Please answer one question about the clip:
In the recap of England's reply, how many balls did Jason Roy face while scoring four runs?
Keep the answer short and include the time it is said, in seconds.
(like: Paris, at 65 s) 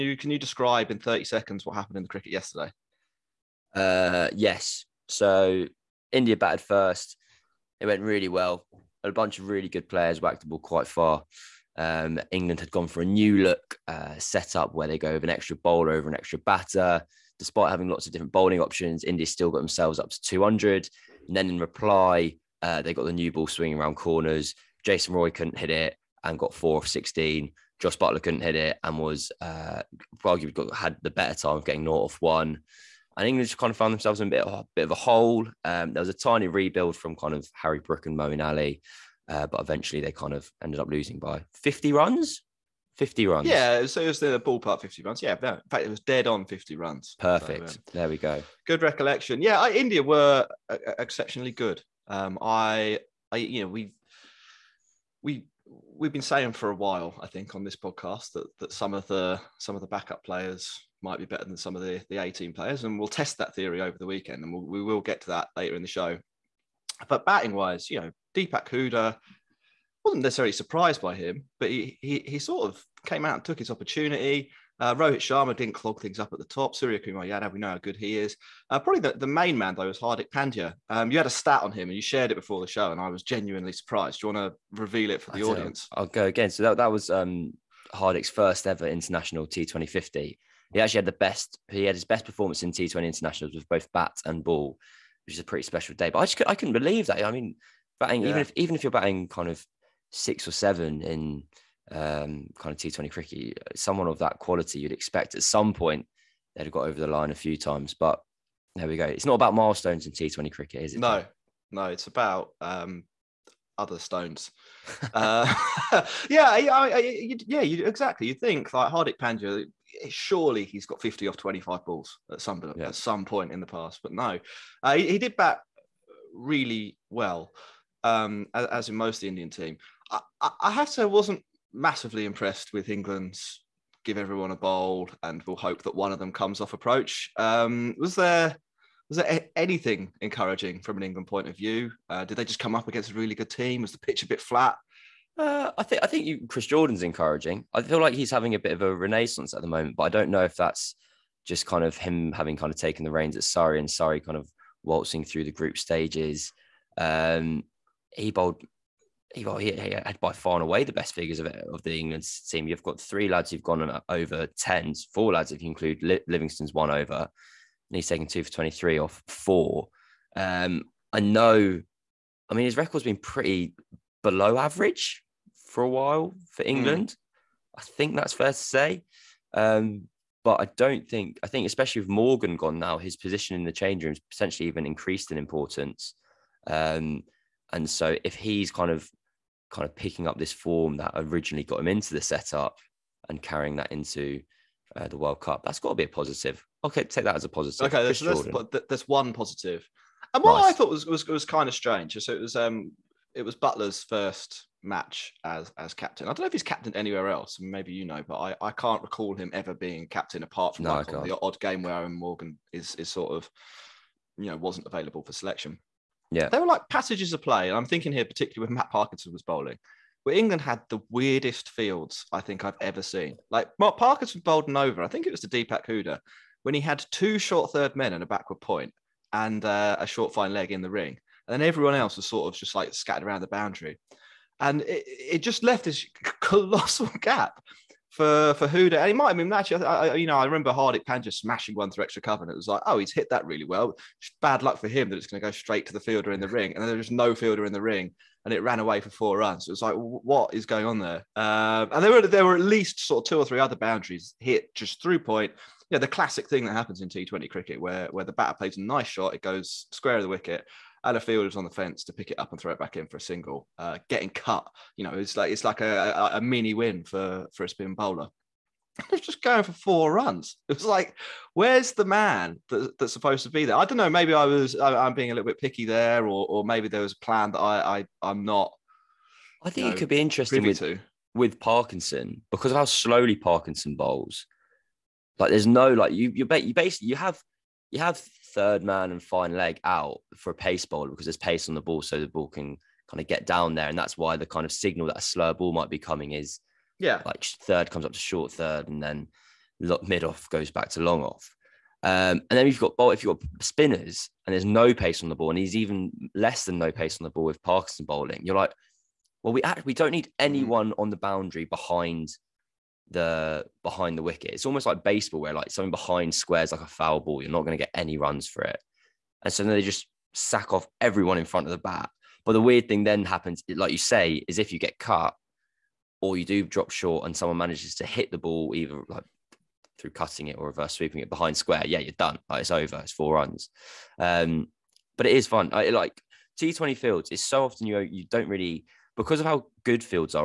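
16, at 26 s.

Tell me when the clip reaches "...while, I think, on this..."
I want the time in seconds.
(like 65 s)
56 s.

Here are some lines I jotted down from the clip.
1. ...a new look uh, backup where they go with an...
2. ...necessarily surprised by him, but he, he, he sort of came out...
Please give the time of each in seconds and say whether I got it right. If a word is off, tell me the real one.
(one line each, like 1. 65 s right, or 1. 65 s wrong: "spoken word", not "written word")
1. 13 s wrong: "setup", not "backup"
2. 70 s right.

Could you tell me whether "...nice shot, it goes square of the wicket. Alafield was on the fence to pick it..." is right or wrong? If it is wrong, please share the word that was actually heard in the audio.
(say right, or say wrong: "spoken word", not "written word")
right.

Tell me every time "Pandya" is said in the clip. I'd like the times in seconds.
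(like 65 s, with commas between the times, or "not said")
80 s, 119 s.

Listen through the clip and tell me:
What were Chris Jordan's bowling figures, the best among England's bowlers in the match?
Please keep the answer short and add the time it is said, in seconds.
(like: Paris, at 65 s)
2 for 23, at 168 s.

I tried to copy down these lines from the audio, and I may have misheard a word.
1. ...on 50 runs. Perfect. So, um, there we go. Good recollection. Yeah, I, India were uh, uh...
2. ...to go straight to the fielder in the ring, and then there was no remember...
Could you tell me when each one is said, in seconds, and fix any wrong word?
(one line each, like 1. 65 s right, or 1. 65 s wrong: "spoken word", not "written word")
1. 46 s right
2. 245 s wrong: "fielder", not "remember".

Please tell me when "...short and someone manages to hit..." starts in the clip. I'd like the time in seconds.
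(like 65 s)
326 s.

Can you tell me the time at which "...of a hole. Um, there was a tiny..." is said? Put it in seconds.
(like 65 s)
34 s.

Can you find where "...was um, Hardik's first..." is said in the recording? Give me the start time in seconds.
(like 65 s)
86 s.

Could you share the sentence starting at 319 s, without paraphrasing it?
And so then they just sack off everyone in front of the bat.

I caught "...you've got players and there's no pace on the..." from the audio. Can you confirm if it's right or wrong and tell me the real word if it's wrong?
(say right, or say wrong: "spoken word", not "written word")
wrong: "spinners", not "players".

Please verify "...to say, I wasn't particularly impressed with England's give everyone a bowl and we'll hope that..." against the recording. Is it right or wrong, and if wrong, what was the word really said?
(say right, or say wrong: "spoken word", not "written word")
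wrong: "massively", not "particularly".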